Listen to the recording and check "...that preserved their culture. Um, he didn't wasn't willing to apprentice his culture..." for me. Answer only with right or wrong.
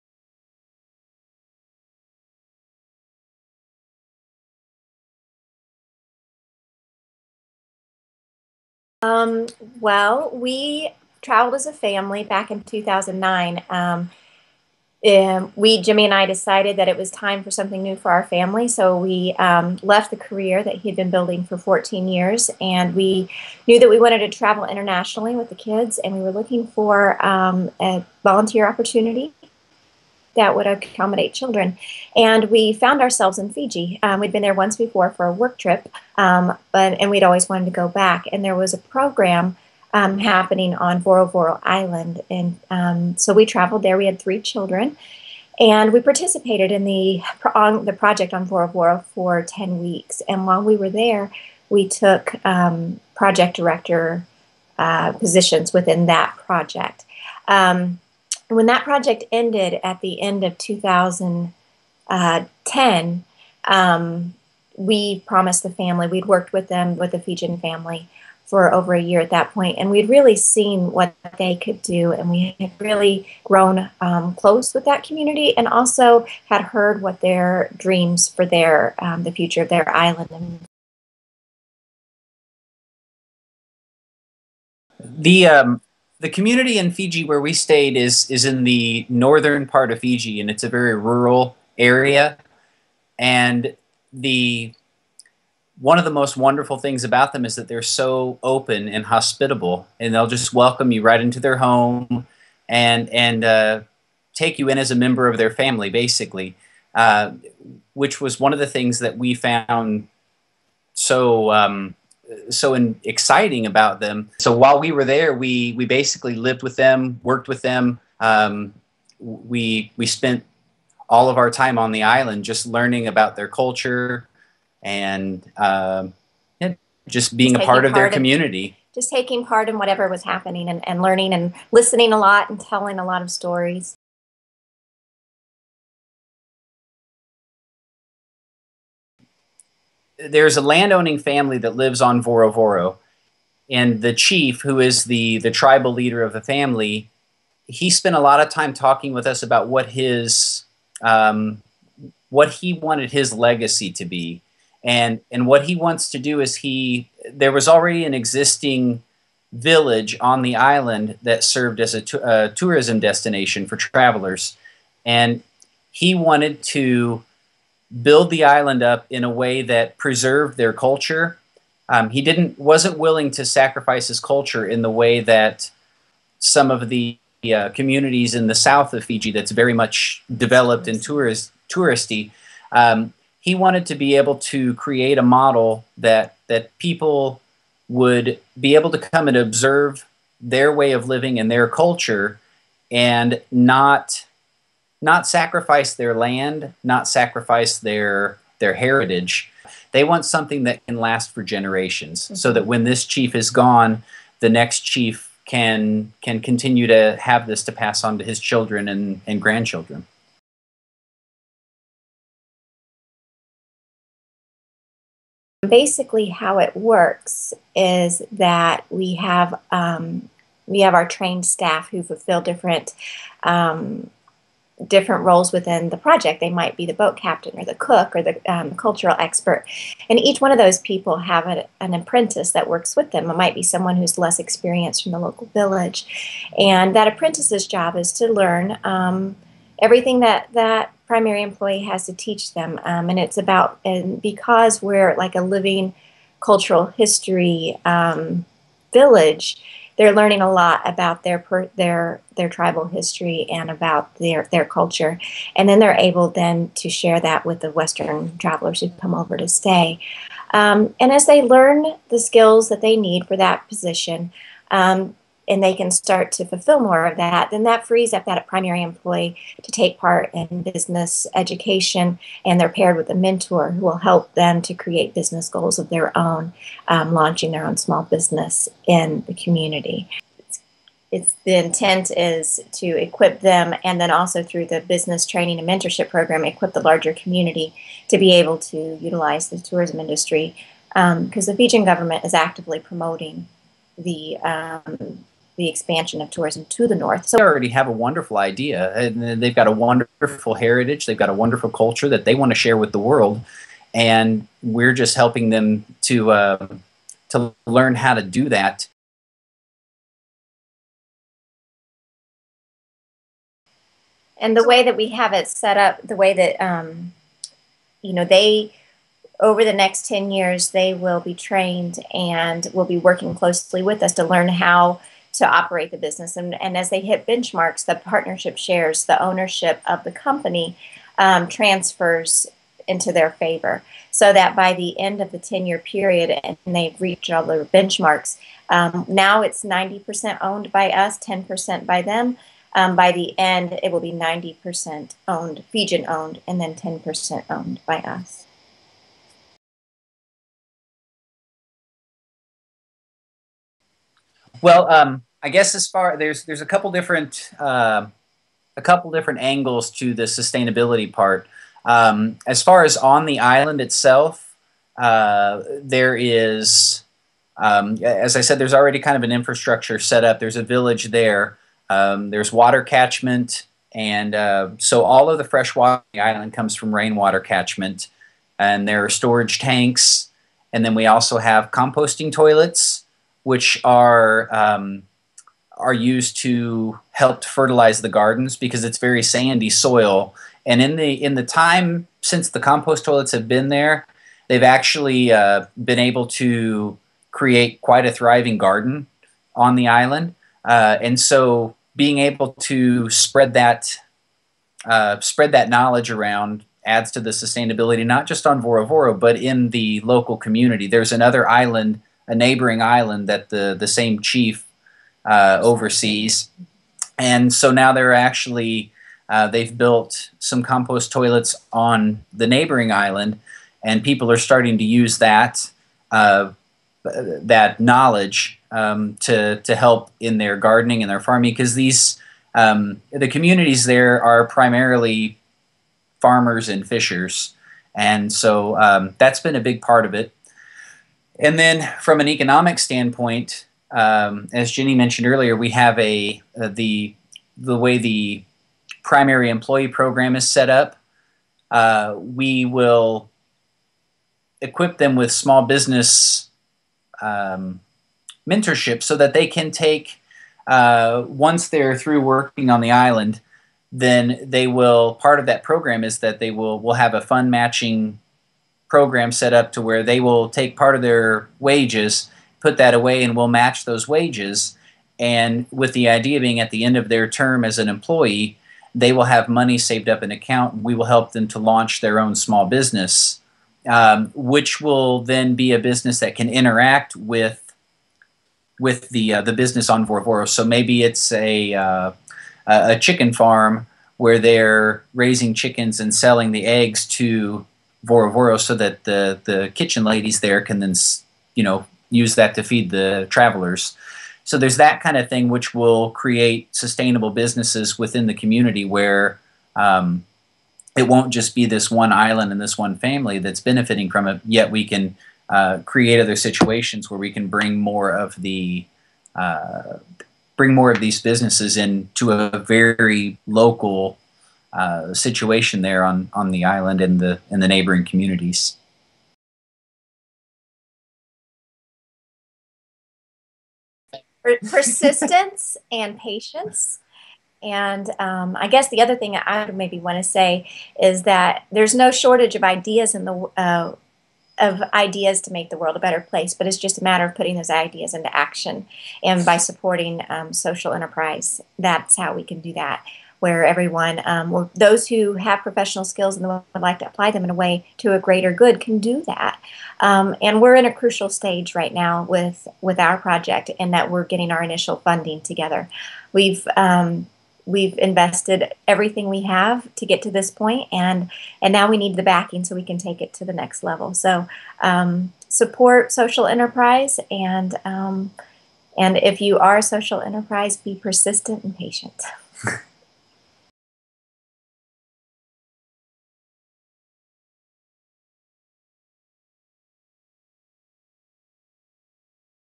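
wrong.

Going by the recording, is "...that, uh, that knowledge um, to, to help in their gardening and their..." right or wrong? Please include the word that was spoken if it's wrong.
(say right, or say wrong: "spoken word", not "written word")
right.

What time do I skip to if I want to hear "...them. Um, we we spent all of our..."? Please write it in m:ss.
1:57.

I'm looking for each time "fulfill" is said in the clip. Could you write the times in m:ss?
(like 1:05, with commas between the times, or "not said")
3:42, 4:26.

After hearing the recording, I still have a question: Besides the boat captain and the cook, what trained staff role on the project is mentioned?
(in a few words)
Cultural expert.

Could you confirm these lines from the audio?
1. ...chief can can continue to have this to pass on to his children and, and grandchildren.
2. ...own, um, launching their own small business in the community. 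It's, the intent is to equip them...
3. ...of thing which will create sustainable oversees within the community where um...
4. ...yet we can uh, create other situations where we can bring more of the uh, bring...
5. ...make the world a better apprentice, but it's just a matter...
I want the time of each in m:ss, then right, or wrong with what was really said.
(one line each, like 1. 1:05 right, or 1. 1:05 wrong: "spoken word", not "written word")
1. 3:24 right
2. 4:36 right
3. 8:25 wrong: "businesses", not "oversees"
4. 8:34 right
5. 9:05 wrong: "place", not "apprentice".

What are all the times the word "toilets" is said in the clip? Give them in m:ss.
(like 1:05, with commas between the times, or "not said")
6:22, 6:33, 7:01.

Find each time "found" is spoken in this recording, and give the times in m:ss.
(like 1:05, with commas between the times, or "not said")
0:32, 1:49.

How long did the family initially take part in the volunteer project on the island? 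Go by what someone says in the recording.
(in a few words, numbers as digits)
10 weeks.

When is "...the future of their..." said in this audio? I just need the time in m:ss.
1:19.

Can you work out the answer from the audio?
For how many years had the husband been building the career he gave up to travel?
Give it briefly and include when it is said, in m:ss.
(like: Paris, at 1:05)
14, at 0:21.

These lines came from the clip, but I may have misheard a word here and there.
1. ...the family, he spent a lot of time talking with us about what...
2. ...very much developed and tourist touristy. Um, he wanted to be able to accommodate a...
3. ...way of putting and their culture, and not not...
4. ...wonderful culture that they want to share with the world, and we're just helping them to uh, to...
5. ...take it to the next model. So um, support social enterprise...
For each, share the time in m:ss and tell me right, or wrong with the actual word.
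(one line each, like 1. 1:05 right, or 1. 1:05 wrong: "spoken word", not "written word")
1. 2:26 right
2. 2:59 wrong: "create", not "accommodate"
3. 3:10 wrong: "living", not "putting"
4. 5:01 right
5. 9:32 wrong: "level", not "model".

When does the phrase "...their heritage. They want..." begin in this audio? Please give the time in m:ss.
3:18.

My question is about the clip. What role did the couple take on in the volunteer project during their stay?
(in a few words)
Project director.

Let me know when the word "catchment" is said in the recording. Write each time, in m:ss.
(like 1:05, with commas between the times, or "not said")
6:12, 6:17.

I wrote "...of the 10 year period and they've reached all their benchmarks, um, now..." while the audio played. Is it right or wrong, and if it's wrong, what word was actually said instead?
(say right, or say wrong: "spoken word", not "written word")
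right.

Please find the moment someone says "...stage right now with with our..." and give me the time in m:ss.
9:21.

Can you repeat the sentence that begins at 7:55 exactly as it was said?
And with the idea being at the end of their term as an employee, they will have money saved up in account.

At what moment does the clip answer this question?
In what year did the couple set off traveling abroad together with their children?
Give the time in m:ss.
0:12.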